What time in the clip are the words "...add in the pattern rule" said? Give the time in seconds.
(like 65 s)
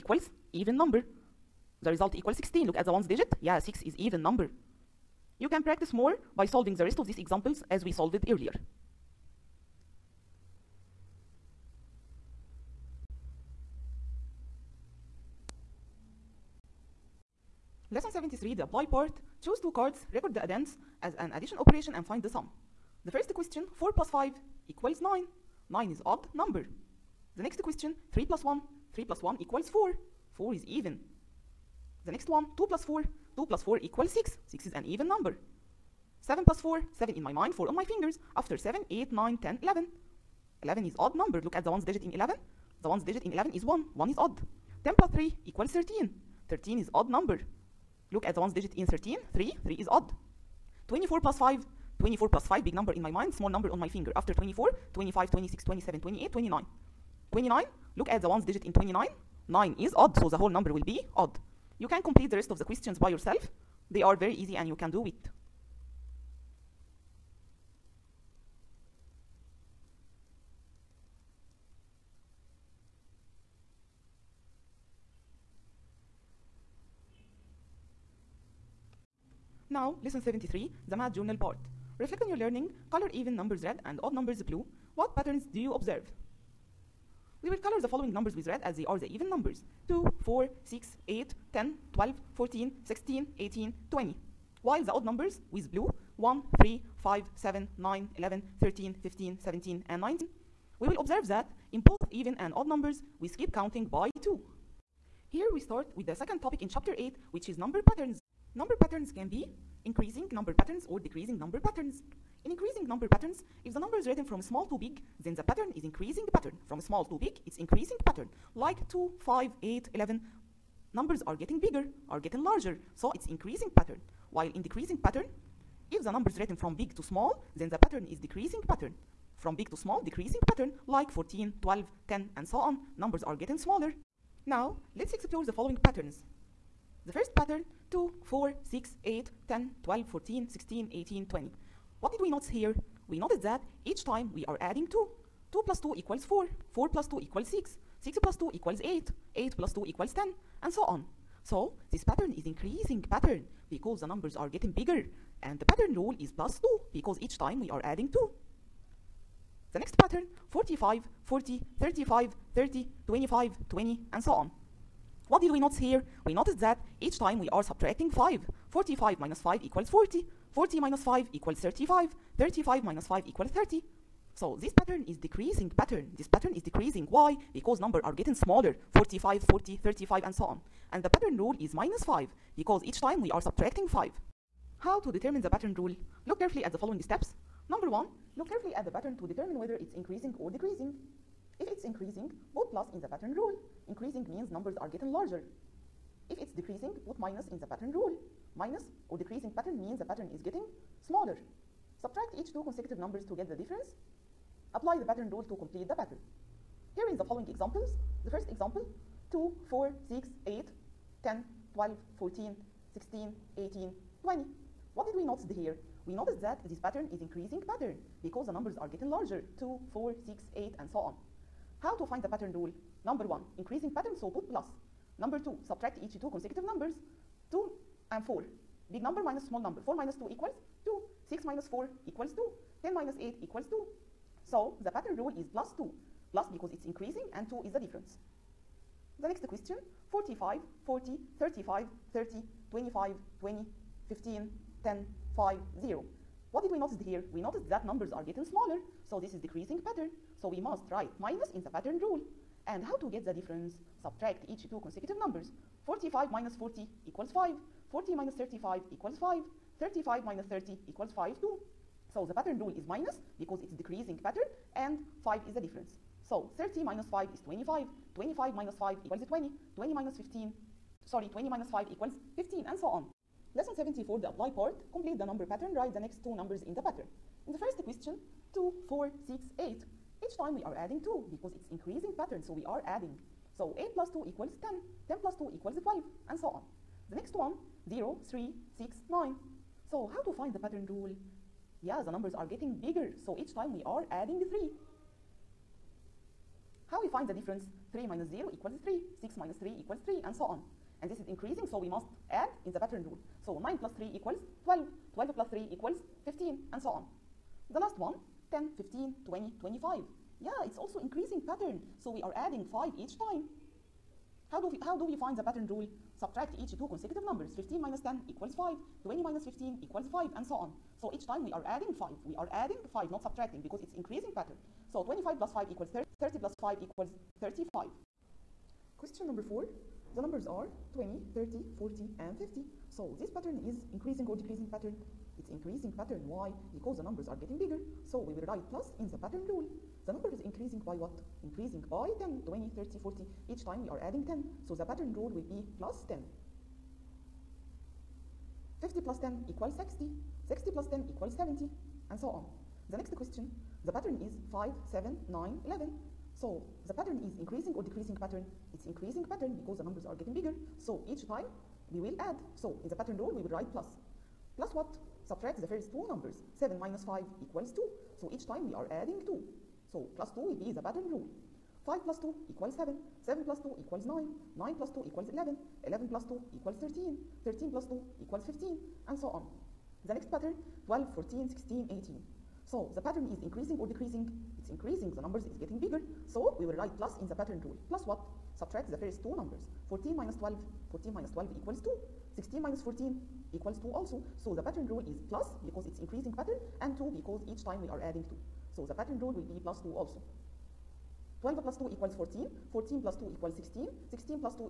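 302 s.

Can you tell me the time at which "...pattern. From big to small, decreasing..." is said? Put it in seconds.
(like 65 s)
128 s.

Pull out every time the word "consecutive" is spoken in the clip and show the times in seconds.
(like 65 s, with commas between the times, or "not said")
202 s, 226 s, 254 s, 316 s.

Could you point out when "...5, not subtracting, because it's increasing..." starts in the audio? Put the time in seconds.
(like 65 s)
322 s.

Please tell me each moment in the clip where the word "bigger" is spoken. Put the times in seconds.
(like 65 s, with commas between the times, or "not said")
121 s, 154 s, 292 s, 337 s, 360 s, 385 s.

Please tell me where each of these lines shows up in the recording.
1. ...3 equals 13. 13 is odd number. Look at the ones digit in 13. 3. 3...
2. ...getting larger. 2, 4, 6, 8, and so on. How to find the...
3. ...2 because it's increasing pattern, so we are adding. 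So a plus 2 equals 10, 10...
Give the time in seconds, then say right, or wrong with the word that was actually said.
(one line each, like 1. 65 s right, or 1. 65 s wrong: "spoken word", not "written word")
1. 45 s right
2. 218 s right
3. 281 s right.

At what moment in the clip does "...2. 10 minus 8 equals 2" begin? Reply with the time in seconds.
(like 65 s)
232 s.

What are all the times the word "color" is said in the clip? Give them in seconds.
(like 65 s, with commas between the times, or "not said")
82 s, 87 s.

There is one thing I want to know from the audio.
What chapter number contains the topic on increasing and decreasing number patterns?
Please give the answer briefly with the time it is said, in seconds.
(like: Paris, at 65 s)
8, at 106 s.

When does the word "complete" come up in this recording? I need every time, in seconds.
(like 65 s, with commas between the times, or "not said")
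62 s, 205 s, 274 s.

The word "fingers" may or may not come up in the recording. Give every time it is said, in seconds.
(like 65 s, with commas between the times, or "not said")
37 s, 53 s.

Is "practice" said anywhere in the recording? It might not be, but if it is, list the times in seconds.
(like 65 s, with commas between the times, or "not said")
5 s.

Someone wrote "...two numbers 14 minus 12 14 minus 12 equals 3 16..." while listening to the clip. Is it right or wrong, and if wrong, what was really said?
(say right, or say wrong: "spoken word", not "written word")
wrong: "2", not "3".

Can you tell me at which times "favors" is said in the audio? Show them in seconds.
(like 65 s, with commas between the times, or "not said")
not said.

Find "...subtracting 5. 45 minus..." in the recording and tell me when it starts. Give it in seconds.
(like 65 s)
167 s.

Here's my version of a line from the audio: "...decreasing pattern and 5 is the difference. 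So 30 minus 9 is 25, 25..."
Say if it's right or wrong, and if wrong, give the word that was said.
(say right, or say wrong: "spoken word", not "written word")
wrong: "5", not "9".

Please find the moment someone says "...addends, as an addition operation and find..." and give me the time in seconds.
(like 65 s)
20 s.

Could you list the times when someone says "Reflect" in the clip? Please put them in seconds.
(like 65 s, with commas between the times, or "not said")
81 s.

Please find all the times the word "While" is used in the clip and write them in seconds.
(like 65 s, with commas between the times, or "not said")
94 s, 124 s.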